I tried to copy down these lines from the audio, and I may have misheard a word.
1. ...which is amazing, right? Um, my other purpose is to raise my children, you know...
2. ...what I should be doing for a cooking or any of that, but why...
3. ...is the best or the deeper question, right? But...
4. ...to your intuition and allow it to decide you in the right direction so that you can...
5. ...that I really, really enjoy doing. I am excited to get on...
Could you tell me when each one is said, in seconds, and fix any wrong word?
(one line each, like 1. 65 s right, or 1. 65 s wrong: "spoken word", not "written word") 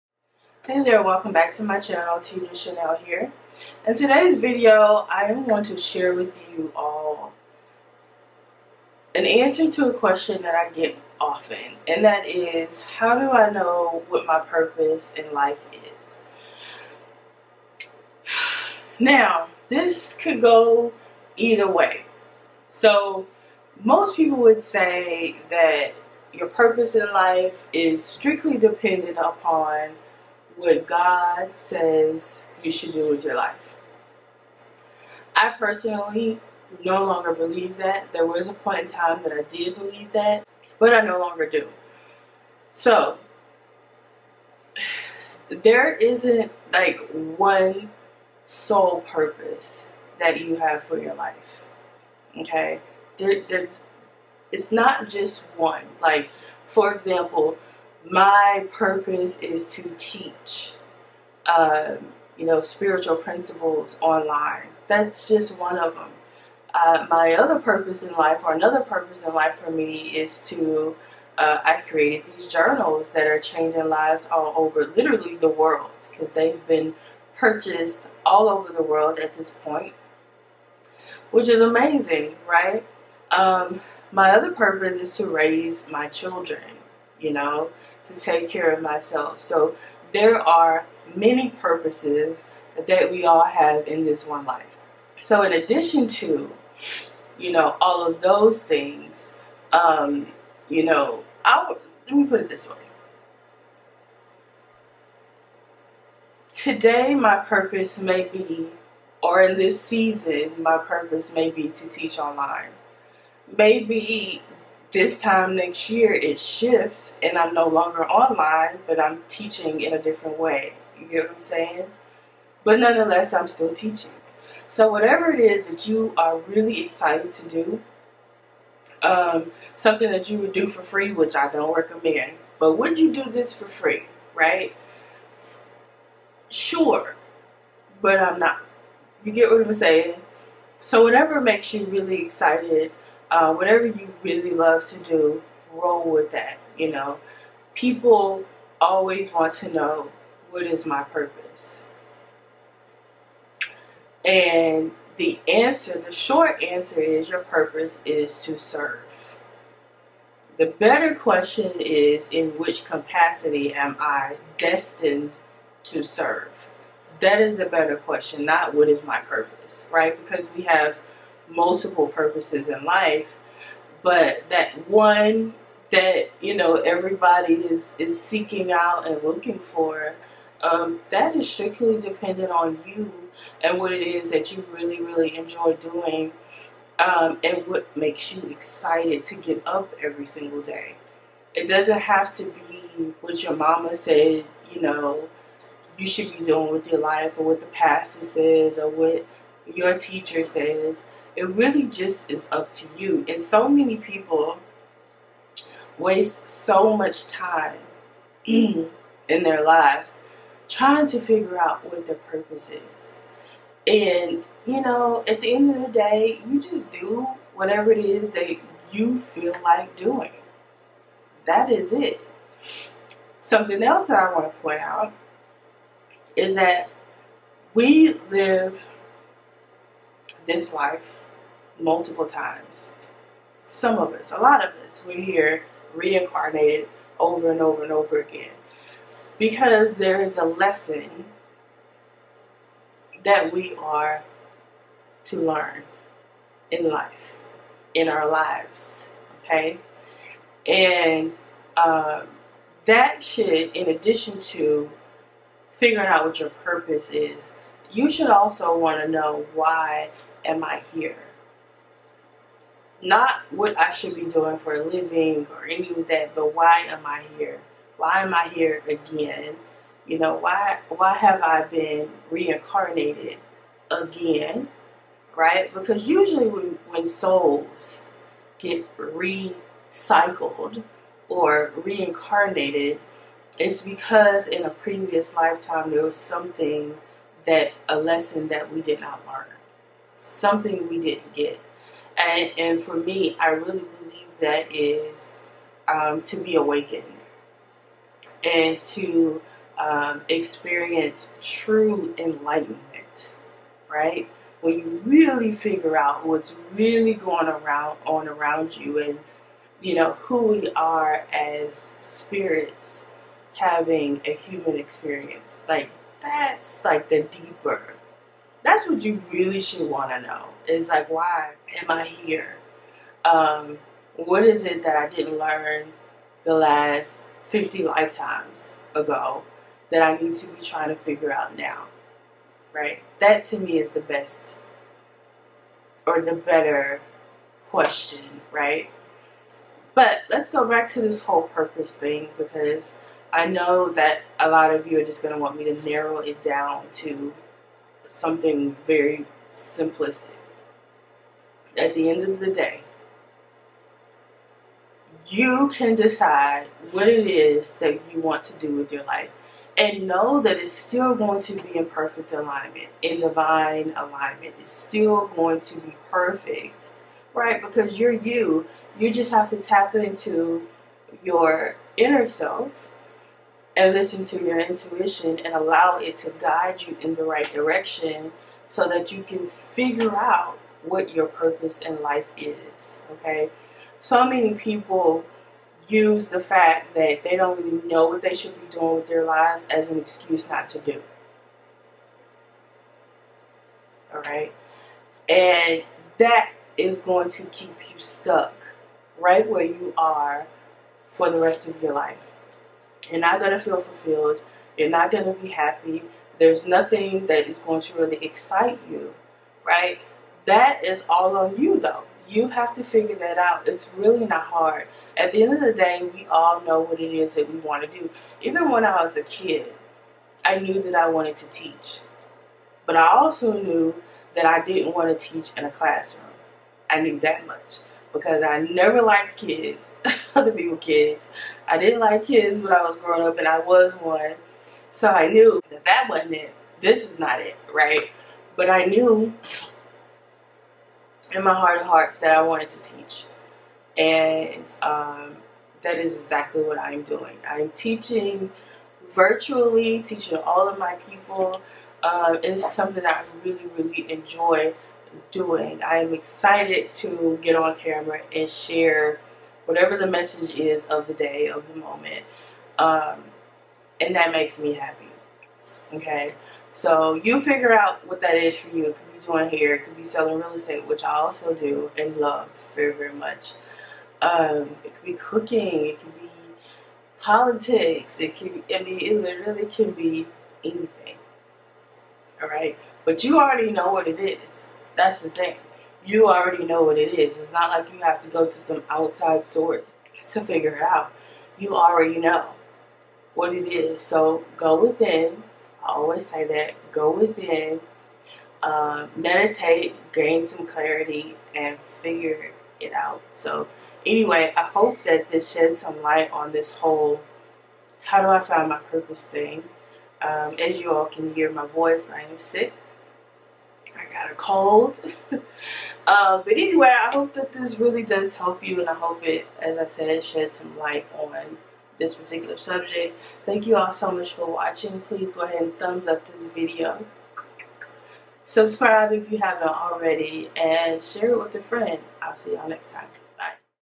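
1. 81 s right
2. 263 s wrong: "living", not "cooking"
3. 333 s wrong: "better", not "deeper"
4. 374 s wrong: "guide", not "decide"
5. 453 s right.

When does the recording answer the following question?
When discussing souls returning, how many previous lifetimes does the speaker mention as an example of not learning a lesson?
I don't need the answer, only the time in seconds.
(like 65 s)
327 s.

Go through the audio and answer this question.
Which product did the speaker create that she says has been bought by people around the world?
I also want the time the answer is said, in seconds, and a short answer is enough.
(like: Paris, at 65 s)
journals, at 72 s.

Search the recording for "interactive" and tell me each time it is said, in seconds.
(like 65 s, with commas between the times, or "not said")
not said.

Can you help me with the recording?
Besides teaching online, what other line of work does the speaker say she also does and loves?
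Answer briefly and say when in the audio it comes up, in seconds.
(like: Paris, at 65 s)
real estate, at 470 s.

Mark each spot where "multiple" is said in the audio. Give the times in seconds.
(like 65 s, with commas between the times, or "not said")
171 s, 231 s.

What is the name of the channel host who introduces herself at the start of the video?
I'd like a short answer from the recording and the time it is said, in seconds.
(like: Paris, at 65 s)
Tedra Chanel, at 2 s.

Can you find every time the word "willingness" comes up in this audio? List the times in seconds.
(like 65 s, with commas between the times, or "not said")
not said.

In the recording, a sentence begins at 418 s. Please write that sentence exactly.
Even when I was a kid, I knew that I wanted to teach.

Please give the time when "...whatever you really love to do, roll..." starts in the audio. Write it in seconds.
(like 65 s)
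143 s.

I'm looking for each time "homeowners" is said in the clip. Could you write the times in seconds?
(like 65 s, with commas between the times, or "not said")
not said.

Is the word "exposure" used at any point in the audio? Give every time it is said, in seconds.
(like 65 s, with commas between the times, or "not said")
not said.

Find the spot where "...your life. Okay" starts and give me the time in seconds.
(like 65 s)
50 s.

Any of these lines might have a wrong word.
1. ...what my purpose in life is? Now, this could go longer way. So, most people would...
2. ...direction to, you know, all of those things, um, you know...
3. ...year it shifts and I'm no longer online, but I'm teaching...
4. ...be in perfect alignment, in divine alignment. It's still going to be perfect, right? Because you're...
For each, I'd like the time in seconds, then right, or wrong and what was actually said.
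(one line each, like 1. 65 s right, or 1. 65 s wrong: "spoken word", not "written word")
1. 14 s wrong: "either", not "longer"
2. 95 s wrong: "addition", not "direction"
3. 115 s right
4. 361 s right.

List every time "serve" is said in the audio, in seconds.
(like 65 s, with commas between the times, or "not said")
158 s, 166 s.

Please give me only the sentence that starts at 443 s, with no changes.
And um, that is exactly what I'm doing.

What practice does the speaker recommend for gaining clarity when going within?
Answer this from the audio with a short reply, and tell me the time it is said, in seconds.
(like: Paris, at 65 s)
meditate, at 499 s.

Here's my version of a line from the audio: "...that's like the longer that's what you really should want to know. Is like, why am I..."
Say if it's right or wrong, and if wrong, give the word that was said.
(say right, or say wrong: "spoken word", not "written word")
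wrong: "deeper", not "longer".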